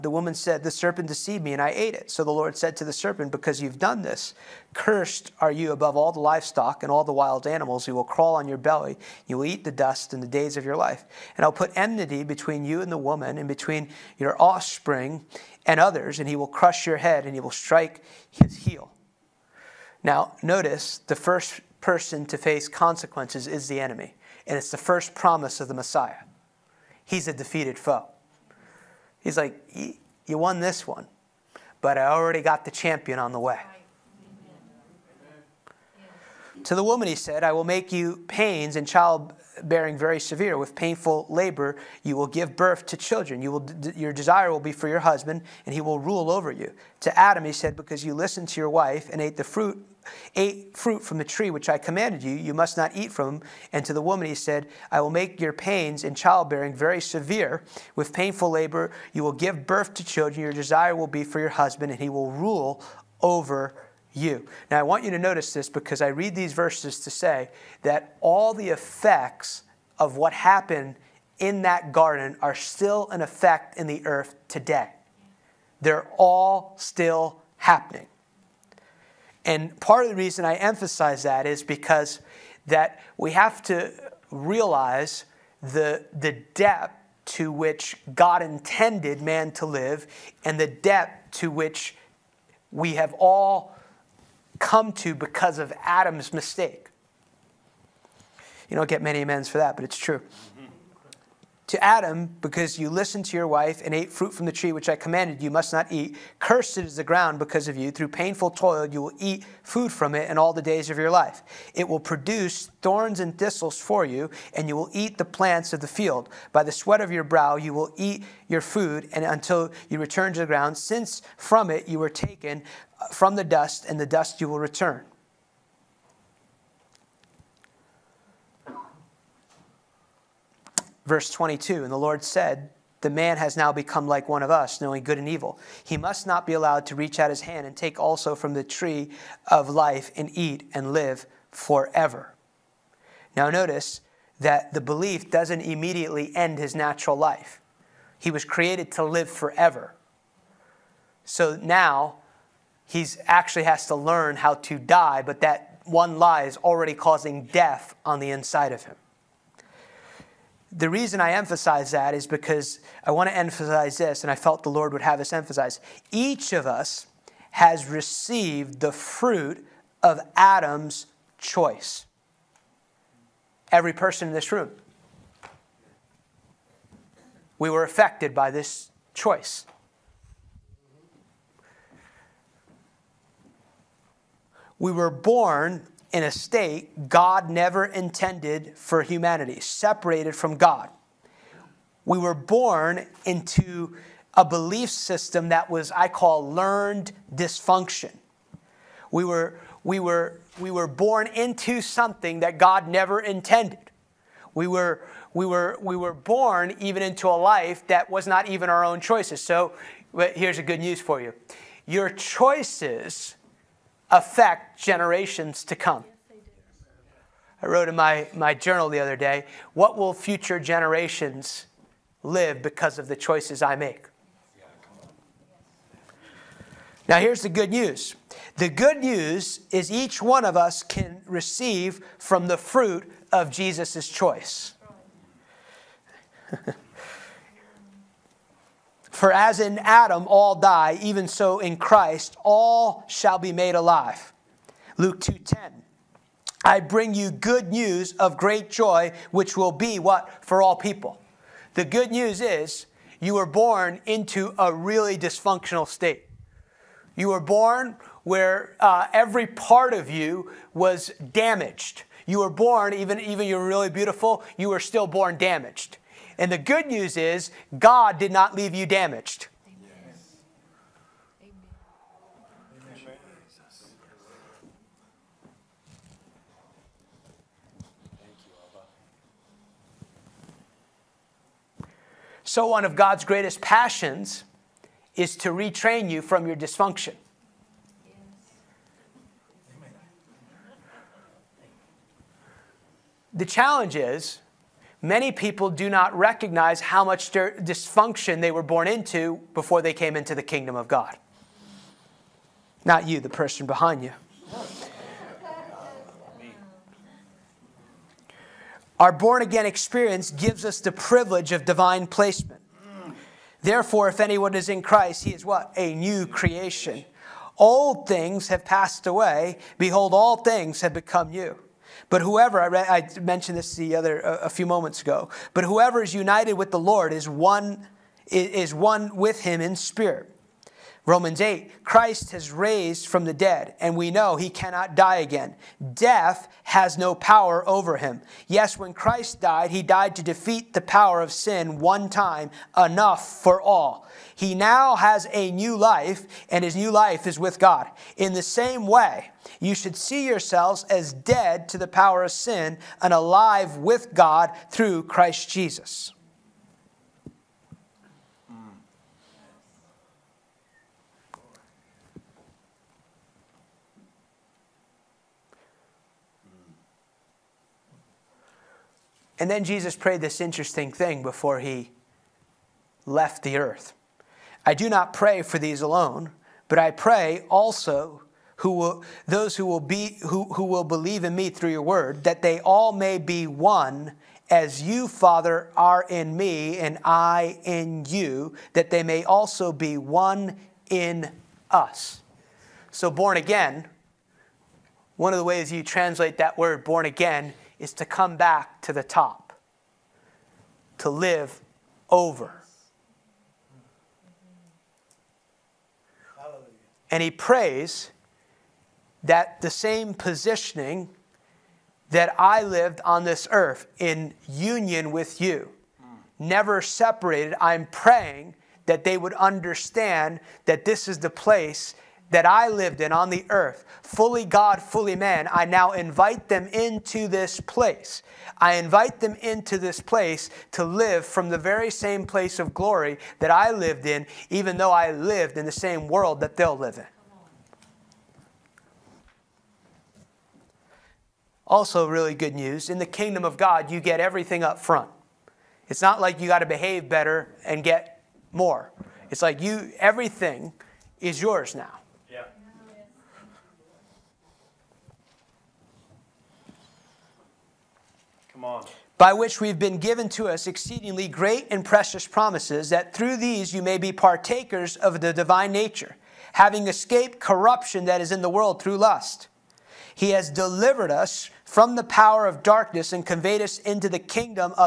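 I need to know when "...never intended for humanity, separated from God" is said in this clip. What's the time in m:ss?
3:07.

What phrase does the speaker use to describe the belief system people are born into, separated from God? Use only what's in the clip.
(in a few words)
Learned dysfunction.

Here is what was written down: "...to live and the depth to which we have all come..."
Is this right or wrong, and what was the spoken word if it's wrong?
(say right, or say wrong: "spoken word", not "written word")
right.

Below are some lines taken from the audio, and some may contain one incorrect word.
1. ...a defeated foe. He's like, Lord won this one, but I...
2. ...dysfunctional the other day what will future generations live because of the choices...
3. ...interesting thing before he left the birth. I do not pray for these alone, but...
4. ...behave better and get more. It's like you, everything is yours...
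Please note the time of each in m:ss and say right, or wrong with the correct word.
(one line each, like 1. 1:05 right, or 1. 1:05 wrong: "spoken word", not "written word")
1. 0:27 wrong: "You", not "Lord"
2. 3:38 wrong: "journal", not "dysfunctional"
3. 6:10 wrong: "earth", not "birth"
4. 7:26 right.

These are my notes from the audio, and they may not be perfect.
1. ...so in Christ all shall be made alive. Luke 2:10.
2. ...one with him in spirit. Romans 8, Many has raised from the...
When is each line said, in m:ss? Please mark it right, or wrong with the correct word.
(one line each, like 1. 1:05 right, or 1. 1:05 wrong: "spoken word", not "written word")
1. 4:01 right
2. 5:28 wrong: "Christ", not "Many".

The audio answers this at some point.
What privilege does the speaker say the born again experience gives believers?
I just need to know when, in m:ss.
5:11.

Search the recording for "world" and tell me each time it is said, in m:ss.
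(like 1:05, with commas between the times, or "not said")
7:16, 7:48.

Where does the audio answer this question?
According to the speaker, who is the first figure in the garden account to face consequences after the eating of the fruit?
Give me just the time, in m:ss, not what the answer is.
0:23.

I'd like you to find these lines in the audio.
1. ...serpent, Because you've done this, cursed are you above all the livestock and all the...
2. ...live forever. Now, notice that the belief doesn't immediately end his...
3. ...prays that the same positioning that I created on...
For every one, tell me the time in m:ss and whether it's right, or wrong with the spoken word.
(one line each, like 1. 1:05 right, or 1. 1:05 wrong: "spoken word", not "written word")
1. 0:02 right
2. 2:20 right
3. 6:47 wrong: "lived", not "created".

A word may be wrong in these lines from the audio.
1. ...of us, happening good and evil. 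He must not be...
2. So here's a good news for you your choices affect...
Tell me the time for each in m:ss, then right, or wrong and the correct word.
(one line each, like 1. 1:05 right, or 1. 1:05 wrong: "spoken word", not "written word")
1. 2:14 wrong: "knowing", not "happening"
2. 3:29 right.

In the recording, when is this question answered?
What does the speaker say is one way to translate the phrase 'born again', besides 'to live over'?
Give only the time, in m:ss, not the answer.
6:37.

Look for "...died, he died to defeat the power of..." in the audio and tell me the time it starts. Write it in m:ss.
5:39.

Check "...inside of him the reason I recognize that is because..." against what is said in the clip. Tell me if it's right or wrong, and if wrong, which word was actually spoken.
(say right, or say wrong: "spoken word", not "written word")
wrong: "emphasize", not "recognize".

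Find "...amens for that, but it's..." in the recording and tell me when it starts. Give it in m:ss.
1:39.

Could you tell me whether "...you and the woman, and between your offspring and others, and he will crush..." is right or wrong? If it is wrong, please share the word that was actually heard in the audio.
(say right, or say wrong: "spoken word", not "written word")
right.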